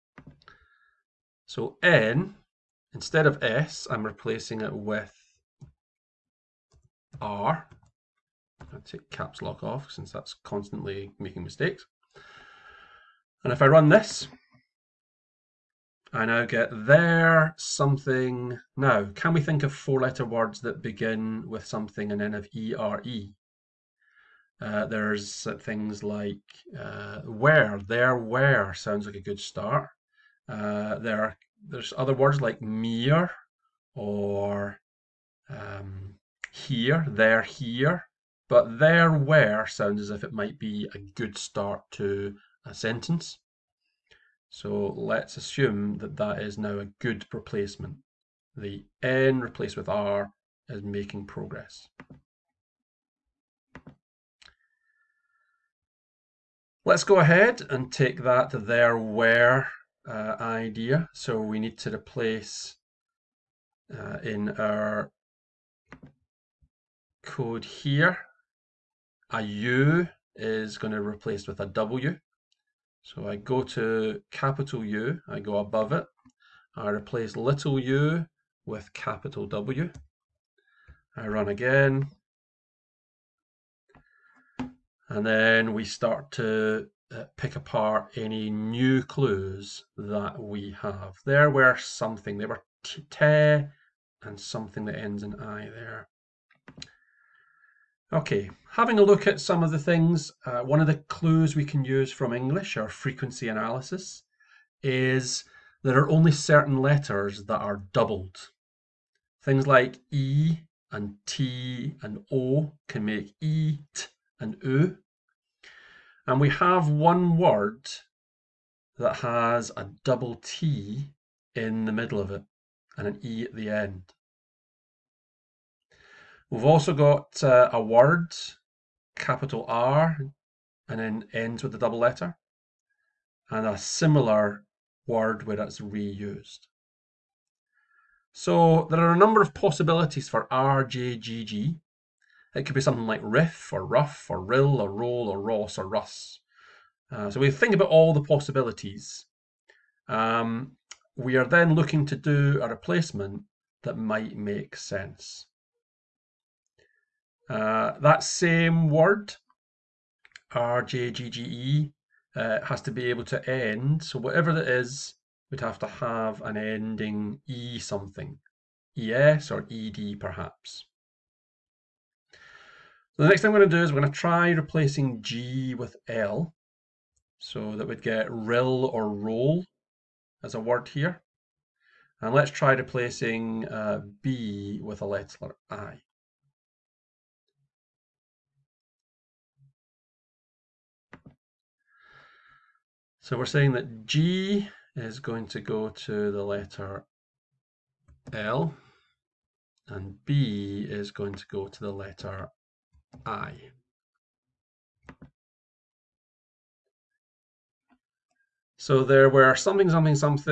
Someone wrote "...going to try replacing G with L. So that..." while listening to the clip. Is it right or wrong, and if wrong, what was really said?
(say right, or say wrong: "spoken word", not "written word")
right.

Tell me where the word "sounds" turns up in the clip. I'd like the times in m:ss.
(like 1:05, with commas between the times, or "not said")
0:28, 0:39.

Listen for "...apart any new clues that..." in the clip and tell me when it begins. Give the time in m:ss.
1:27.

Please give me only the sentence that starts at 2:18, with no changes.
So there are a number of possibilities for RJGG.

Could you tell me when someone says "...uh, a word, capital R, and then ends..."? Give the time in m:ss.
2:07.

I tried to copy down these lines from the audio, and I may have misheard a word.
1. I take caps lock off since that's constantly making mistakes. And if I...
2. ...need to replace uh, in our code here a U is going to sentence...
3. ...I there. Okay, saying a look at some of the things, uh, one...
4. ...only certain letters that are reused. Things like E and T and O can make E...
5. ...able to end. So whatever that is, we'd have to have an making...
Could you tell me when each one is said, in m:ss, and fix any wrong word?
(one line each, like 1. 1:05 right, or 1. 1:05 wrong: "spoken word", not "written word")
1. 0:08 right
2. 1:01 wrong: "replace", not "sentence"
3. 1:35 wrong: "having", not "saying"
4. 1:46 wrong: "doubled", not "reused"
5. 2:43 wrong: "ending", not "making".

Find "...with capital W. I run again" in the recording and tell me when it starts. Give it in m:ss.
1:18.